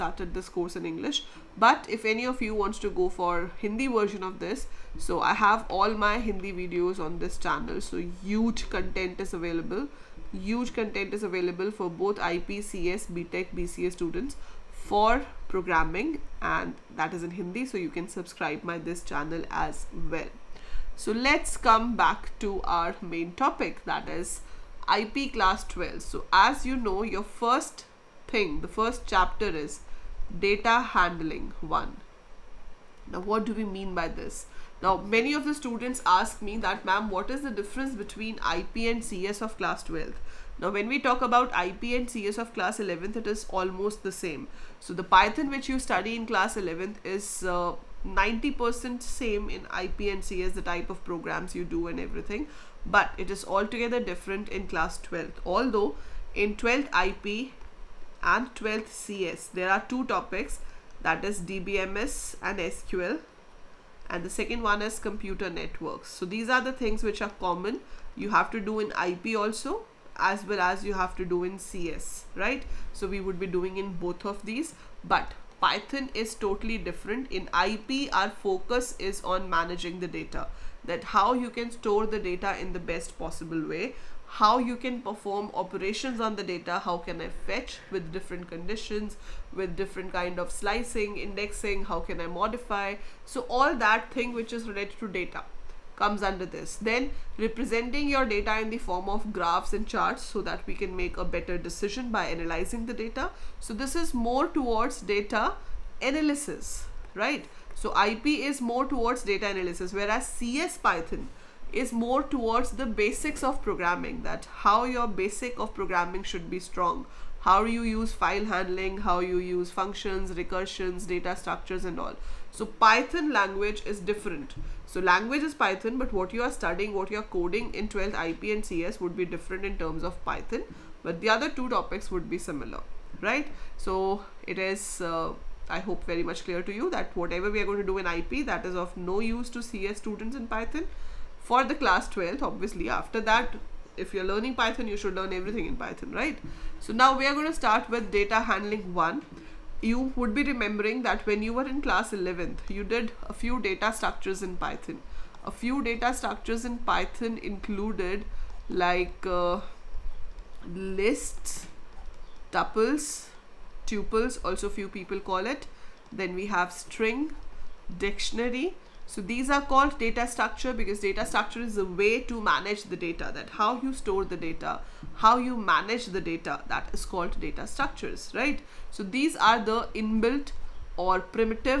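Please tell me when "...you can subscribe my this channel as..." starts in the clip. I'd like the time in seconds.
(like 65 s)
17 s.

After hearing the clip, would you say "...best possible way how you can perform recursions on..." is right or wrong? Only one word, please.
wrong.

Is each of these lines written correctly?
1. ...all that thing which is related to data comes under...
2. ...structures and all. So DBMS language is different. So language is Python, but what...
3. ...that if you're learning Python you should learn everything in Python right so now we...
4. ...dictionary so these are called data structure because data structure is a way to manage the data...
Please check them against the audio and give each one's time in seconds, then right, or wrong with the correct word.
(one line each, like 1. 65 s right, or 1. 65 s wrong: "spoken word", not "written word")
1. 93 s right
2. 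121 s wrong: "Python", not "DBMS"
3. 143 s right
4. 168 s right.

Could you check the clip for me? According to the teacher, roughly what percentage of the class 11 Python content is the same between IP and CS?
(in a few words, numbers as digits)
90%.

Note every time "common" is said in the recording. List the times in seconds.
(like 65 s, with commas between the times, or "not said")
67 s.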